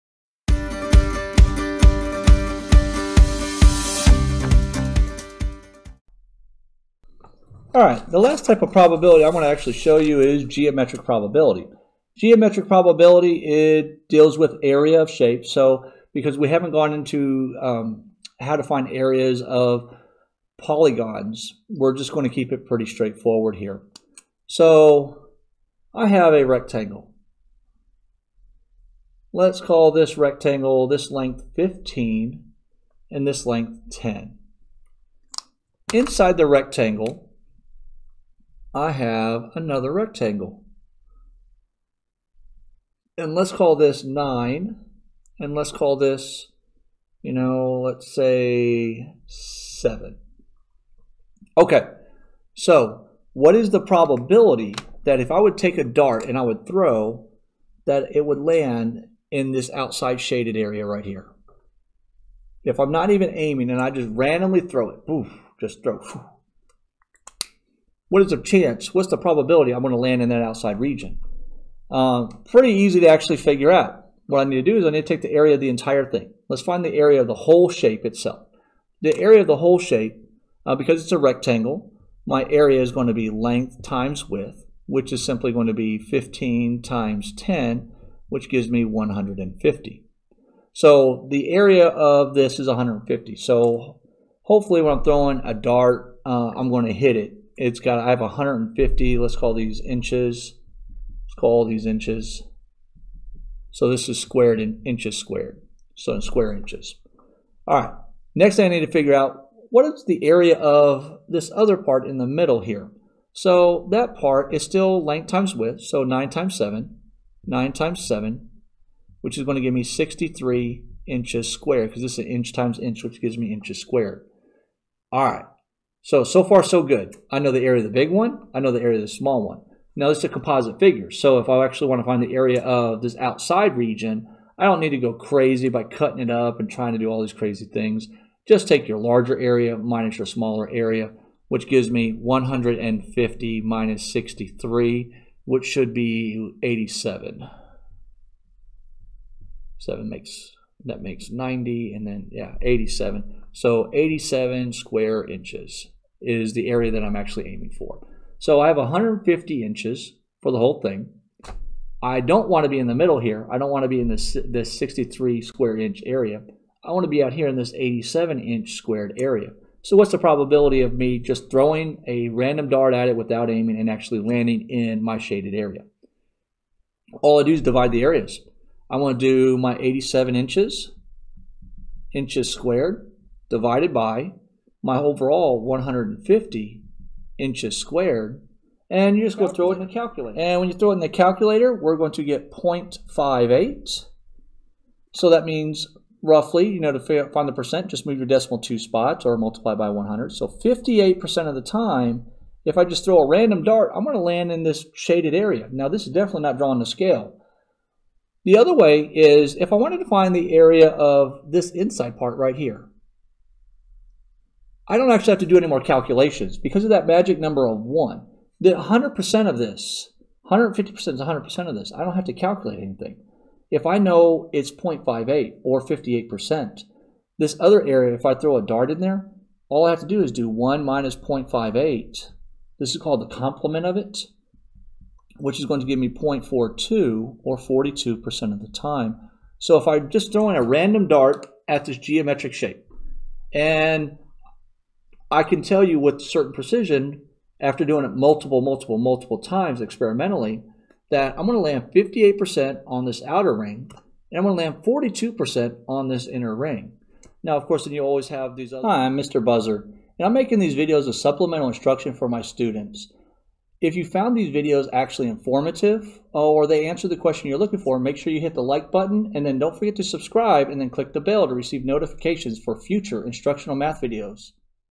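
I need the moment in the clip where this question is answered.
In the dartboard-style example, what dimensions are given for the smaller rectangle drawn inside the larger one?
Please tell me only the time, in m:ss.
0:43.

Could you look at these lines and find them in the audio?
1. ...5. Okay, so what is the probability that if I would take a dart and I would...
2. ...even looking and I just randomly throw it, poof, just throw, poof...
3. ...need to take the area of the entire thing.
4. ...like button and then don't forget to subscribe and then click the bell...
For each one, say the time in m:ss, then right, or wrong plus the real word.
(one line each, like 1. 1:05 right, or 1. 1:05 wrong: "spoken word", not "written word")
1. 0:49 wrong: "7", not "5"
2. 1:03 wrong: "aiming", not "looking"
3. 1:14 right
4. 4:28 right.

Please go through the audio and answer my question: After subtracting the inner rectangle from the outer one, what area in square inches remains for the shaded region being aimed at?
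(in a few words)
87.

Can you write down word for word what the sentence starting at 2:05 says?
All right, so, so far so good.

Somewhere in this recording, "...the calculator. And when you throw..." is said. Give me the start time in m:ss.
3:09.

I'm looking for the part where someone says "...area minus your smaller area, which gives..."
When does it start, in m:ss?
2:19.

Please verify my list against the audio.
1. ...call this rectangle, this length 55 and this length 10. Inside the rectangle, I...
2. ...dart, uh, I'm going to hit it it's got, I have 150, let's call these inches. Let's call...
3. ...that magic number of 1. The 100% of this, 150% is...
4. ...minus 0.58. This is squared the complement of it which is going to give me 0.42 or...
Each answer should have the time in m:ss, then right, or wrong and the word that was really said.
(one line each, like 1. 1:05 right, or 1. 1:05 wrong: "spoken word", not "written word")
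1. 0:29 wrong: "15", not "55"
2. 1:35 right
3. 3:36 right
4. 3:50 wrong: "called", not "squared".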